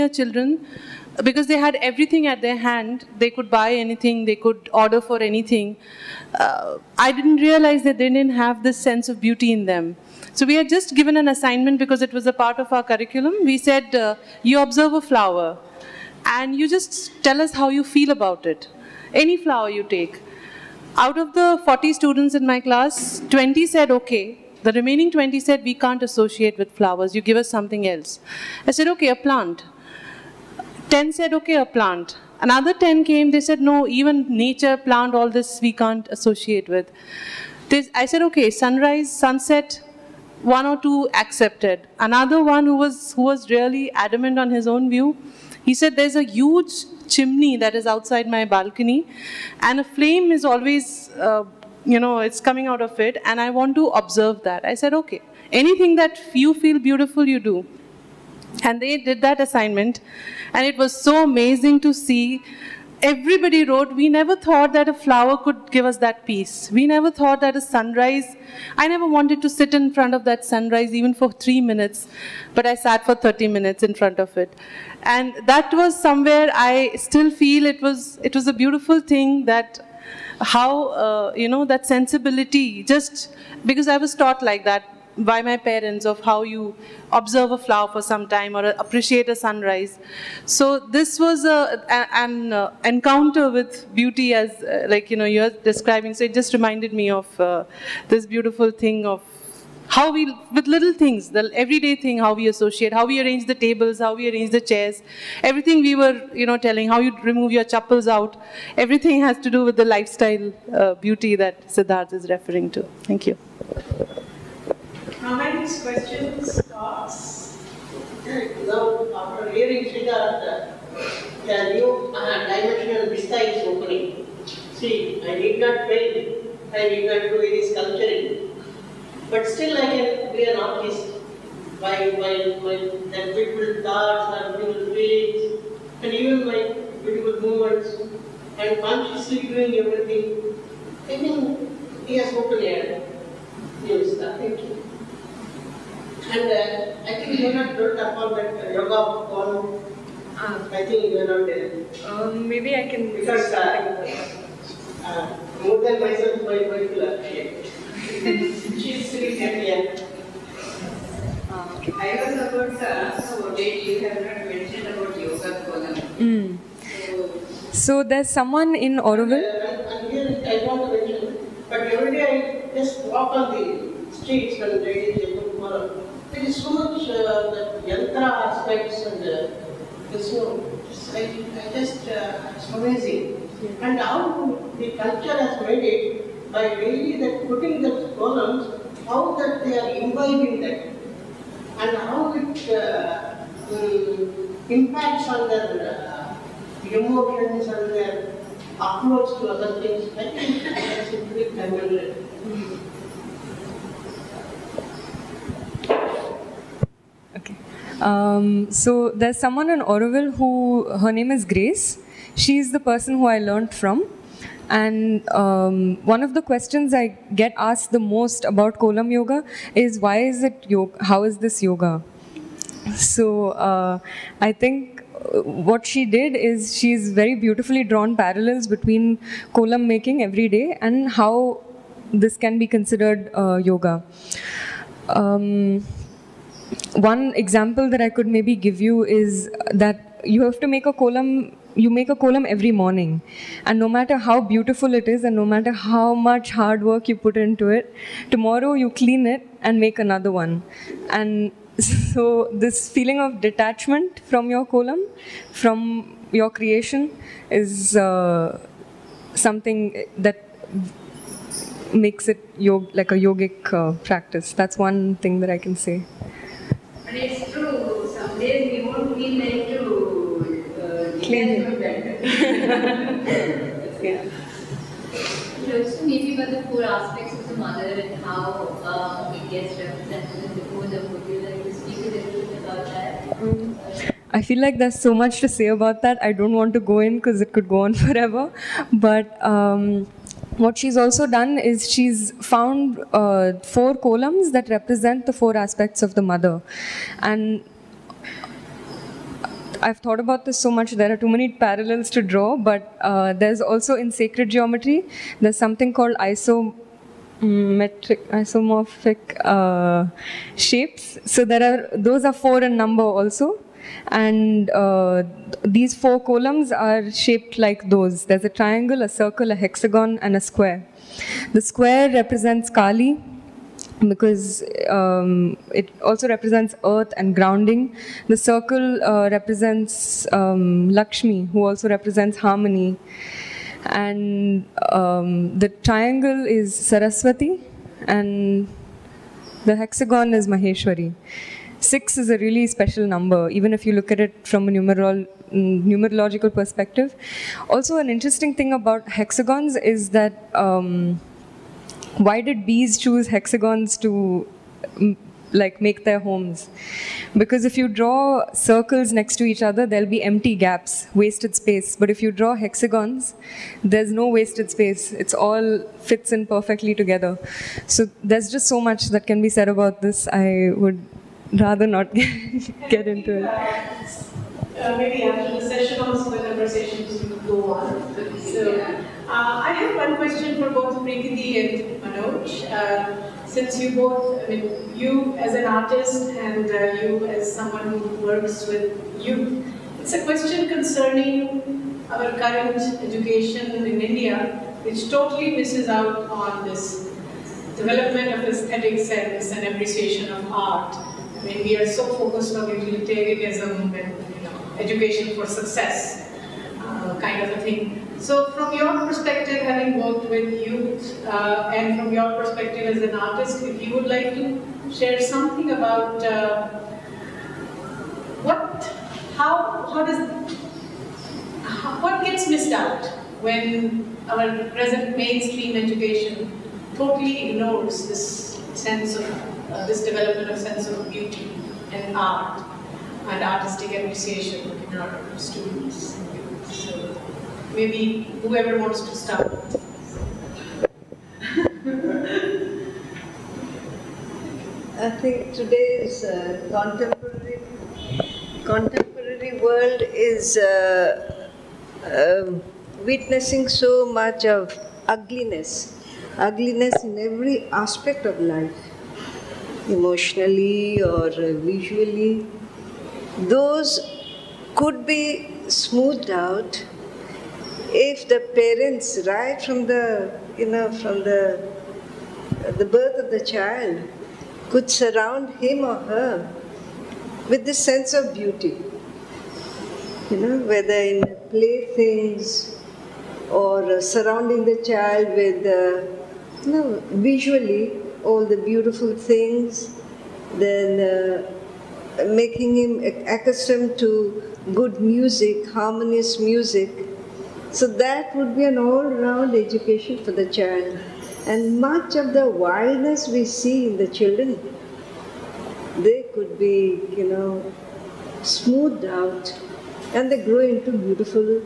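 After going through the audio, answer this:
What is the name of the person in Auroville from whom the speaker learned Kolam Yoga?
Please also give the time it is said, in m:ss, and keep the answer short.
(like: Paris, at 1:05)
Grace, at 3:31.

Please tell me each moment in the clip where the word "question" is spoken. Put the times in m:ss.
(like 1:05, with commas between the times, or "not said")
1:55, 3:36, 6:20, 6:30.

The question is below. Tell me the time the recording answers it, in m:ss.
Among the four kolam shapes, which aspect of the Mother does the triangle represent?
5:36.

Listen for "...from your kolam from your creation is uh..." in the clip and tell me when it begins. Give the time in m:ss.
4:14.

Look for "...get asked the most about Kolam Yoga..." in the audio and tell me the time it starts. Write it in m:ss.
3:37.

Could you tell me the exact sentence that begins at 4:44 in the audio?
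I feel like there's so much to say about that.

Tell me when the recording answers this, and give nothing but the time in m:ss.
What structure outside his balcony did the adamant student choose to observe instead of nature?
0:46.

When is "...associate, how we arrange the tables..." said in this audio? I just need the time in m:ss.
1:42.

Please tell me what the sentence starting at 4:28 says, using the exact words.
Some days we won't feel like to uh, clean it.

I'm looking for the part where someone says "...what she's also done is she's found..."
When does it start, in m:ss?
4:50.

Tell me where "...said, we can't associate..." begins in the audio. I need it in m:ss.
0:25.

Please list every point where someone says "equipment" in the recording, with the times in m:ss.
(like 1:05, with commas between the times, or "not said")
not said.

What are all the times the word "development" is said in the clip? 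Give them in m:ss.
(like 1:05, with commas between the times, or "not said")
6:37, 7:10.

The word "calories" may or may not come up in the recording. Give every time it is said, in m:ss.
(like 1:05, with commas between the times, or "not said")
not said.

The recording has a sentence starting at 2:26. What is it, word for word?
And uh, I think you are not about that yoga call.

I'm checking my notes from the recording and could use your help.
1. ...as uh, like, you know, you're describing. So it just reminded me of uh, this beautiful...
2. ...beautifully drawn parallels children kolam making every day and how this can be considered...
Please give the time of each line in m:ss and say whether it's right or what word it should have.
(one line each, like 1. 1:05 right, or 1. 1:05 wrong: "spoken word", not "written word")
1. 1:34 right
2. 3:47 wrong: "between", not "children".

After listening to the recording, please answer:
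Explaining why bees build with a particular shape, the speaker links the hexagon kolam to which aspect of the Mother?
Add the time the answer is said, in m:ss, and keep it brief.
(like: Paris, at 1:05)
Maheshwari, at 5:40.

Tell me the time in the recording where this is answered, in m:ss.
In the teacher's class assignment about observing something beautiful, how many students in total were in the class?
0:21.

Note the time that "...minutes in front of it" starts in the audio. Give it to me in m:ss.
1:13.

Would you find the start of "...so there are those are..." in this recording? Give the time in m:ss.
5:11.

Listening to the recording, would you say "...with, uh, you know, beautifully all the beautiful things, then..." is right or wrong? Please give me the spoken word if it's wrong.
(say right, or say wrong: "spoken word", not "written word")
wrong: "visually", not "beautifully".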